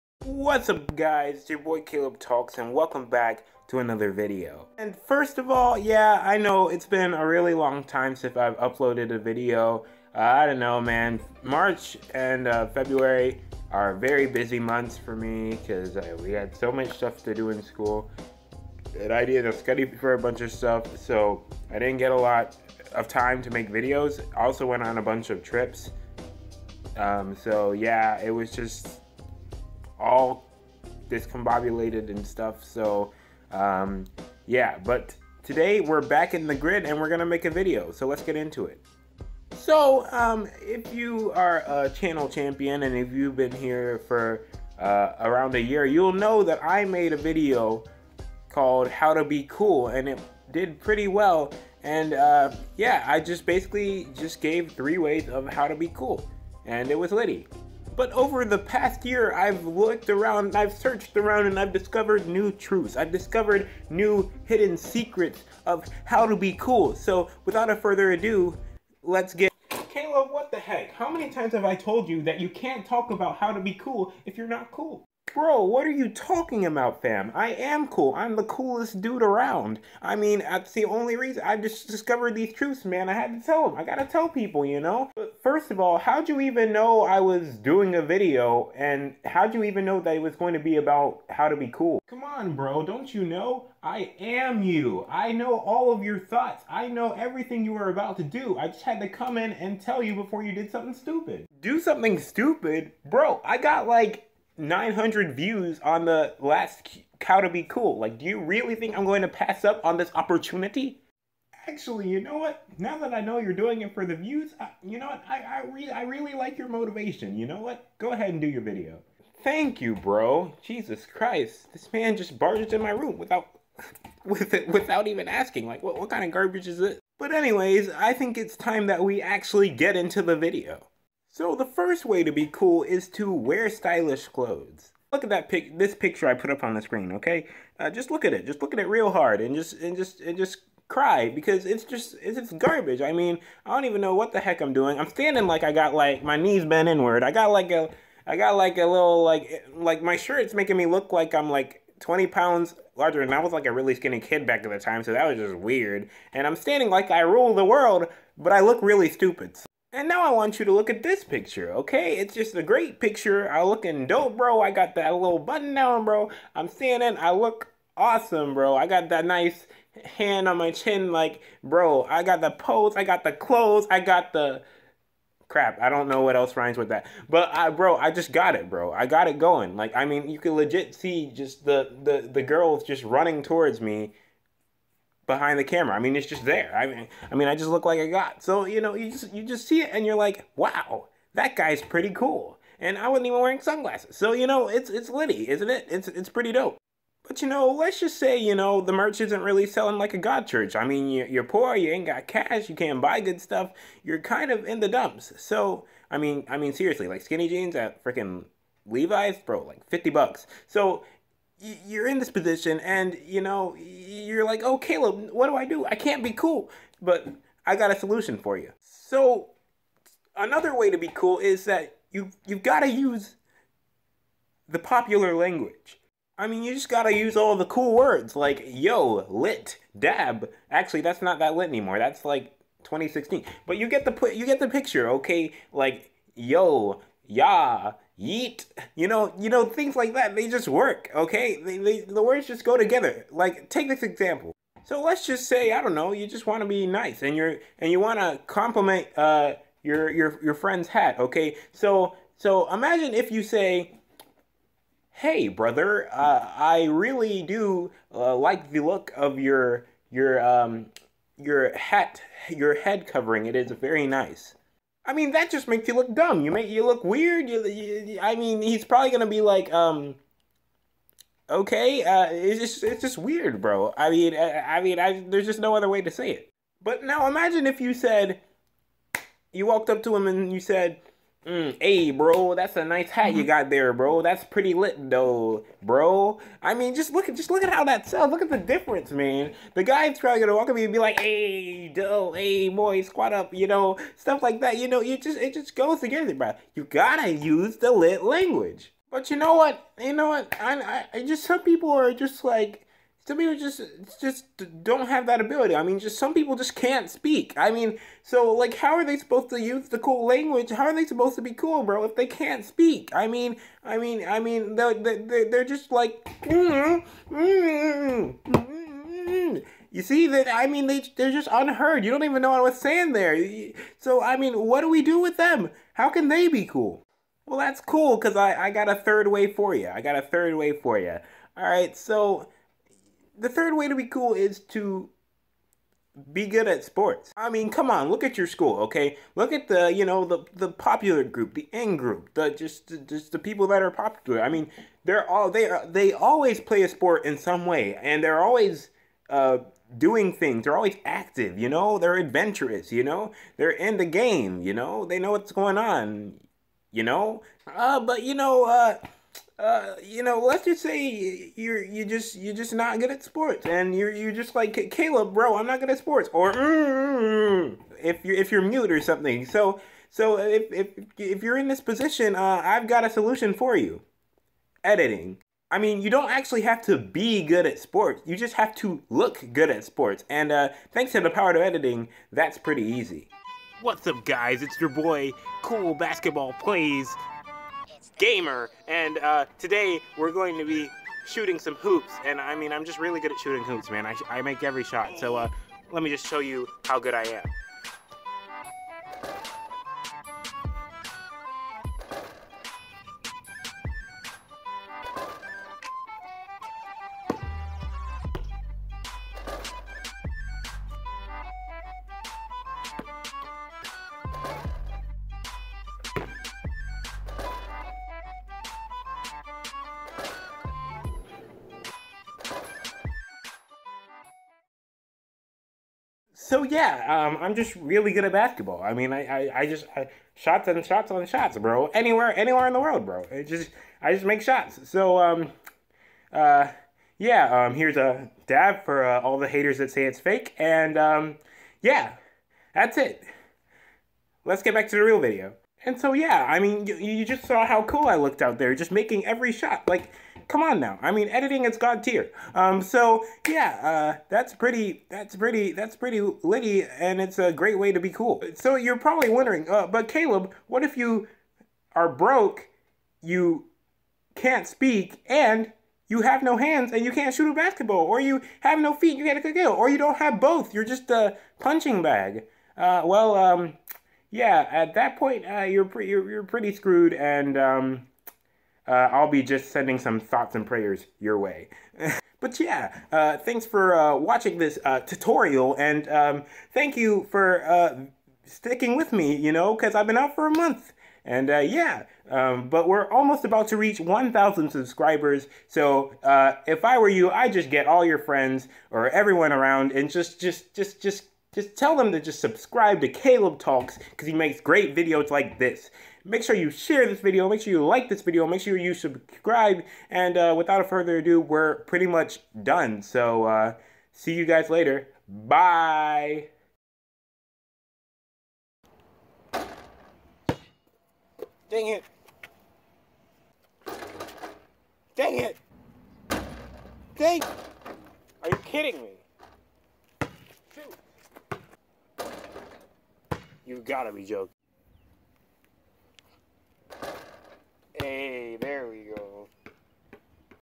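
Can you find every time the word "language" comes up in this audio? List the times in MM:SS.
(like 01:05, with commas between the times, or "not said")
03:45, 04:58, 05:10.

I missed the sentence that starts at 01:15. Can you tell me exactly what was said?
Bro, what are you talking about, fam?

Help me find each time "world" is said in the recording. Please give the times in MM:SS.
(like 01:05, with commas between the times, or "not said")
02:37, 07:12.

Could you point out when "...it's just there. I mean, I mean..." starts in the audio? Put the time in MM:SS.
03:06.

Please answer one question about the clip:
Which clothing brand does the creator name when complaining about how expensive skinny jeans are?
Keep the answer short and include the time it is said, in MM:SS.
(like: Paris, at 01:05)
Levi's, at 03:28.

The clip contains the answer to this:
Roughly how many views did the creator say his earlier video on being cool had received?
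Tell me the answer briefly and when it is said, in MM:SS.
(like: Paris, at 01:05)
900, at 01:44.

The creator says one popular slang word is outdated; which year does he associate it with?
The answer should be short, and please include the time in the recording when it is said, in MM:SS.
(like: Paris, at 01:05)
2016, at 03:52.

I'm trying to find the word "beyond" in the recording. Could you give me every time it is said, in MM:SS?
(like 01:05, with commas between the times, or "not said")
not said.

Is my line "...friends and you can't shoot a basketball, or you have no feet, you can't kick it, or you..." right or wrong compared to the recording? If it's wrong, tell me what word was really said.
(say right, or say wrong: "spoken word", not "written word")
wrong: "hands", not "friends".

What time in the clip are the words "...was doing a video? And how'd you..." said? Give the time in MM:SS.
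01:27.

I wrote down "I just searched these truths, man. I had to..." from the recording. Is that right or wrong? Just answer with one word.
wrong.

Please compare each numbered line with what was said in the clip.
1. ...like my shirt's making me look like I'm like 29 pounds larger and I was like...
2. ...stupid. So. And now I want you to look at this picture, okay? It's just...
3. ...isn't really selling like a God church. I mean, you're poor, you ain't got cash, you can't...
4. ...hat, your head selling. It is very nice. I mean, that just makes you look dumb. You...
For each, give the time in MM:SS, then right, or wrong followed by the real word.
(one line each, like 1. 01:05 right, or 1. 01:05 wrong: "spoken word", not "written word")
1. 02:29 wrong: "20", not "29"
2. 02:39 right
3. 03:19 right
4. 04:21 wrong: "covering", not "selling".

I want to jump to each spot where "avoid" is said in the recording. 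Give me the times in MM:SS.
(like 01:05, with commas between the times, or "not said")
not said.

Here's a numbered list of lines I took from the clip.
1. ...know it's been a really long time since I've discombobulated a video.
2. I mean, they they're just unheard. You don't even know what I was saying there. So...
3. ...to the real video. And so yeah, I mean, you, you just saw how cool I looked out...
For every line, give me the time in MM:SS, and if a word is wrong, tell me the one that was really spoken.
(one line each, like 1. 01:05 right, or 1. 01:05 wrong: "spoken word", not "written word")
1. 00:06 wrong: "uploaded", not "discombobulated"
2. 05:20 right
3. 07:24 right.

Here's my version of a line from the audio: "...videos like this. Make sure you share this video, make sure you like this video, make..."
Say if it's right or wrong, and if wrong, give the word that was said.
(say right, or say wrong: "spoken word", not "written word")
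right.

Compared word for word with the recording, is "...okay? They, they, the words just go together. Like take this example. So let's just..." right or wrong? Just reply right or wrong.
right.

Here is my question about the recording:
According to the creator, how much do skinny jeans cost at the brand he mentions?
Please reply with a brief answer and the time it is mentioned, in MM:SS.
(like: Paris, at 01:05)
50 bucks, at 03:29.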